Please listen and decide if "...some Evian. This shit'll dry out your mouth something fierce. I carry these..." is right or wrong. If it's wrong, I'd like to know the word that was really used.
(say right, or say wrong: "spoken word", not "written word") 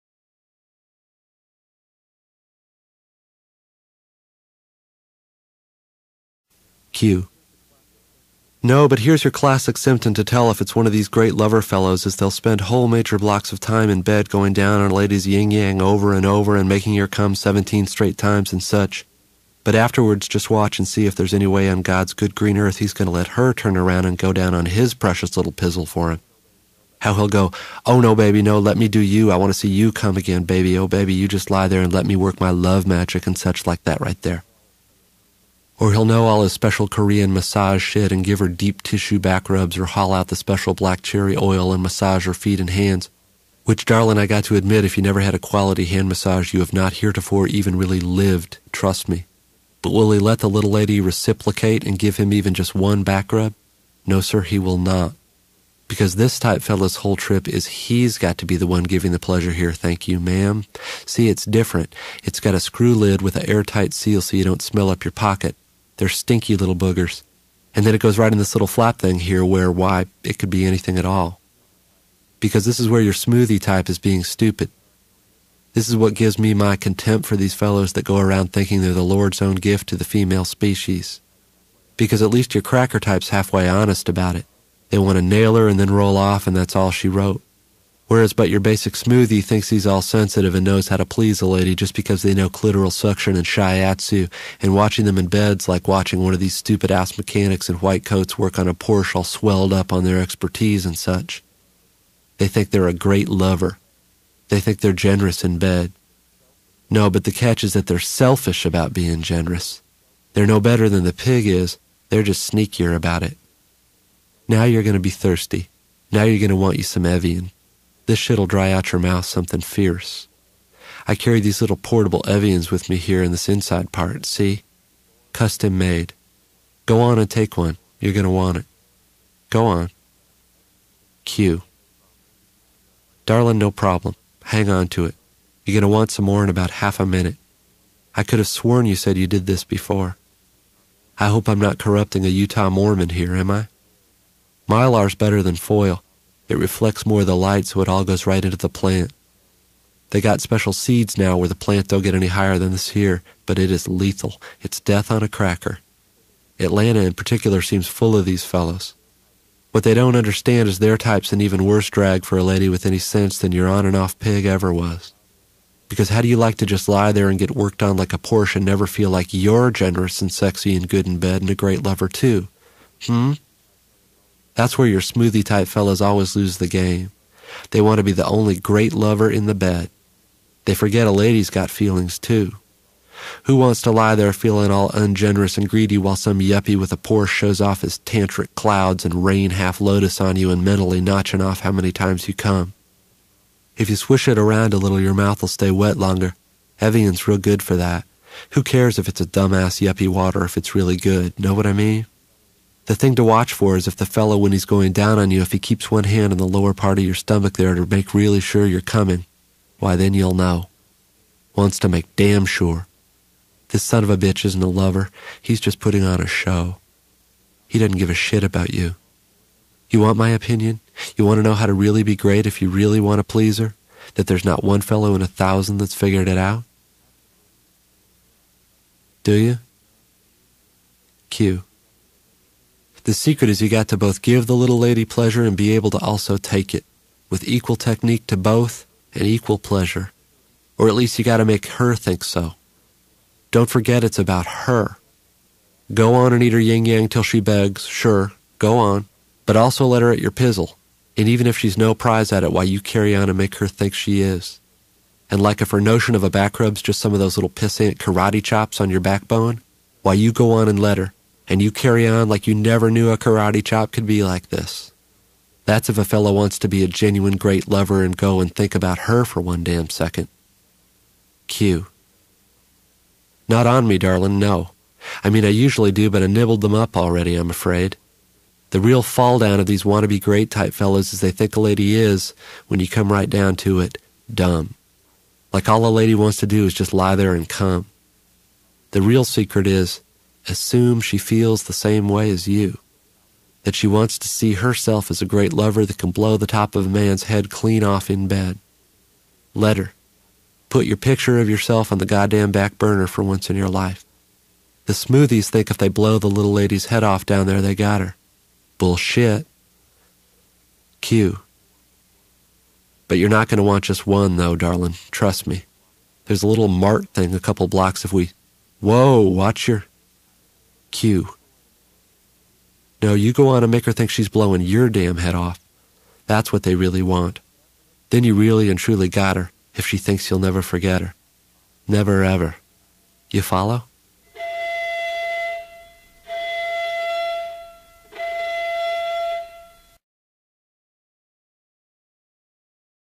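right.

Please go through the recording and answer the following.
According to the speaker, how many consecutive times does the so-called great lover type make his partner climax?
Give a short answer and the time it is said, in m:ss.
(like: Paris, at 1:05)
17, at 0:17.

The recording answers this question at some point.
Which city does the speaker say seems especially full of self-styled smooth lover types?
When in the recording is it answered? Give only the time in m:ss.
2:36.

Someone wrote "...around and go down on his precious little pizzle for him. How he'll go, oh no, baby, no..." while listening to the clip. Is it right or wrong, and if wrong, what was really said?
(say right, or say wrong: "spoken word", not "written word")
right.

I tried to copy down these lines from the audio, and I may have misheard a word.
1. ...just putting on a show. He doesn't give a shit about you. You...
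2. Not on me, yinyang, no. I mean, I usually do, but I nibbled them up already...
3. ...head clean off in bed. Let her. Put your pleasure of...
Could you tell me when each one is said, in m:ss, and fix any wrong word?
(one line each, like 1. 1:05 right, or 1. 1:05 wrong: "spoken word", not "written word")
1. 3:35 right
2. 4:33 wrong: "darling", not "yinyang"
3. 4:57 wrong: "picture", not "pleasure".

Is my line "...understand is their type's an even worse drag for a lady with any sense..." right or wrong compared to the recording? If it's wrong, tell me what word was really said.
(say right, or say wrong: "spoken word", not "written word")
right.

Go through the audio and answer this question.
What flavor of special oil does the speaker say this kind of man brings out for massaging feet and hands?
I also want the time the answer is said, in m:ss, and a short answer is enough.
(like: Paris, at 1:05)
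black cherry, at 0:40.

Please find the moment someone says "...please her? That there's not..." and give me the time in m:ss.
3:43.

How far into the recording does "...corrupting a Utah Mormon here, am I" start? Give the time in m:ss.
2:21.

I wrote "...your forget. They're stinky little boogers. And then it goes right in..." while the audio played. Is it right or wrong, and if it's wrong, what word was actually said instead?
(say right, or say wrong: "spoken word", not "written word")
wrong: "pocket", not "forget".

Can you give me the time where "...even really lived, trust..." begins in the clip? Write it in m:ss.
0:47.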